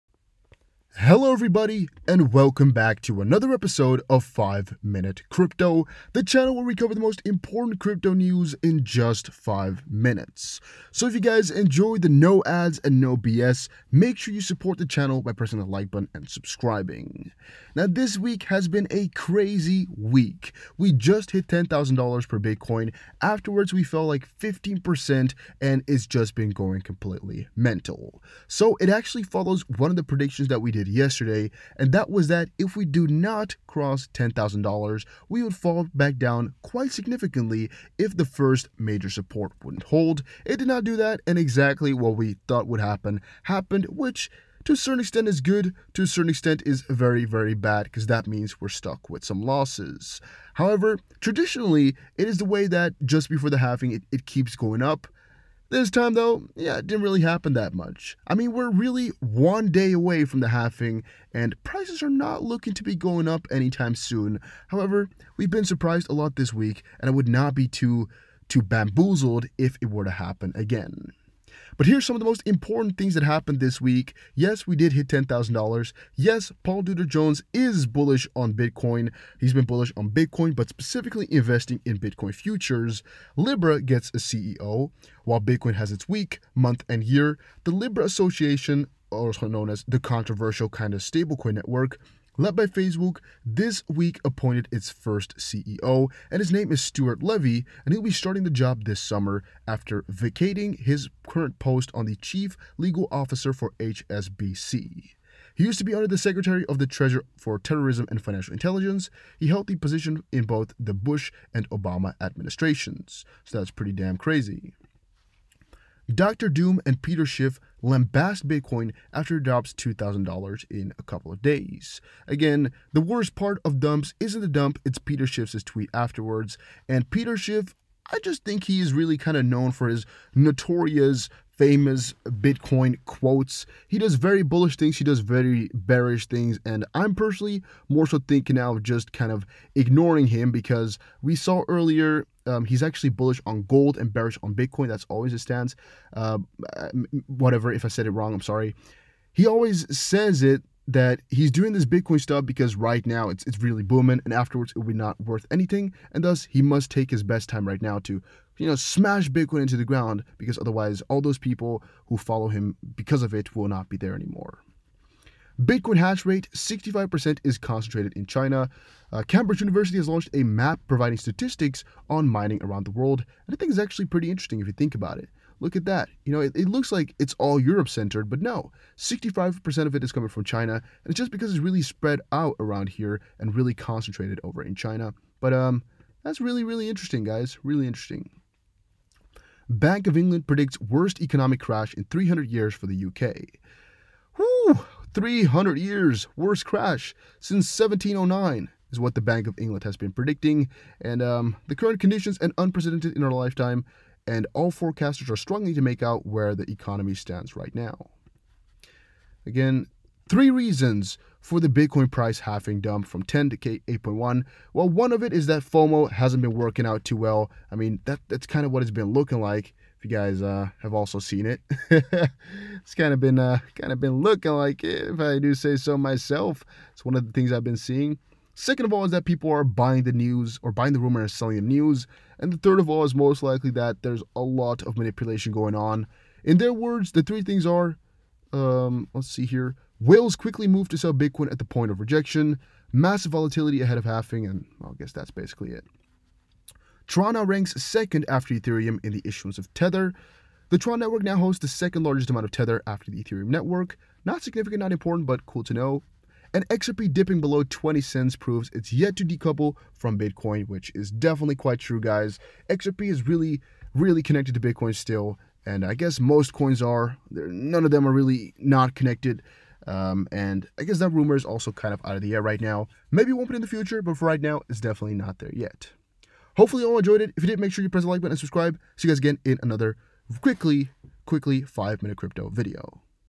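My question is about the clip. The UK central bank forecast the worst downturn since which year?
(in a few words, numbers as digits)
1709.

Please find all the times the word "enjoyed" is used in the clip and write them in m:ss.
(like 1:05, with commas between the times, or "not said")
0:11, 4:36.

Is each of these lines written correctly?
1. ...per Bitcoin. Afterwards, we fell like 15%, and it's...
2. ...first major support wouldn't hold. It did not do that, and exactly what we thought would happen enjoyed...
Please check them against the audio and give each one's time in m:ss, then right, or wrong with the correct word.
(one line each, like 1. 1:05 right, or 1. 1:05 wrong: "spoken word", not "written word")
1. 0:22 right
2. 0:38 wrong: "happened", not "enjoyed".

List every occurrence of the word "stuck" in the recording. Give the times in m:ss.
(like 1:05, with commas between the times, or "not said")
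0:48.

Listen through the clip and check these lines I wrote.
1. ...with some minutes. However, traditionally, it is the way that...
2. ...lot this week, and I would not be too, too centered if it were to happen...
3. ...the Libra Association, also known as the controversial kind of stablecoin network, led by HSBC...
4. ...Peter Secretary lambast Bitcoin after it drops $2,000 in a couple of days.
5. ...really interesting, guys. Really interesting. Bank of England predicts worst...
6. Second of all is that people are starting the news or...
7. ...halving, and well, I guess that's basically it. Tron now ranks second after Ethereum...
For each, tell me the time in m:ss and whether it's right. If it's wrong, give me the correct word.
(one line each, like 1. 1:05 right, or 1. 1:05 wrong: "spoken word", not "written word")
1. 0:49 wrong: "losses", not "minutes"
2. 1:06 wrong: "bamboozled", not "centered"
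3. 1:27 wrong: "Facebook", not "HSBC"
4. 1:57 wrong: "Schiff", not "Secretary"
5. 3:06 right
6. 3:48 wrong: "buying", not "starting"
7. 4:04 right.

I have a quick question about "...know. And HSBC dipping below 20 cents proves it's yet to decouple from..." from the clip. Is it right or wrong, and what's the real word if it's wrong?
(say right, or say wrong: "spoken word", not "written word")
wrong: "XRP", not "HSBC".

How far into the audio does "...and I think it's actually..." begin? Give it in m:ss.
2:53.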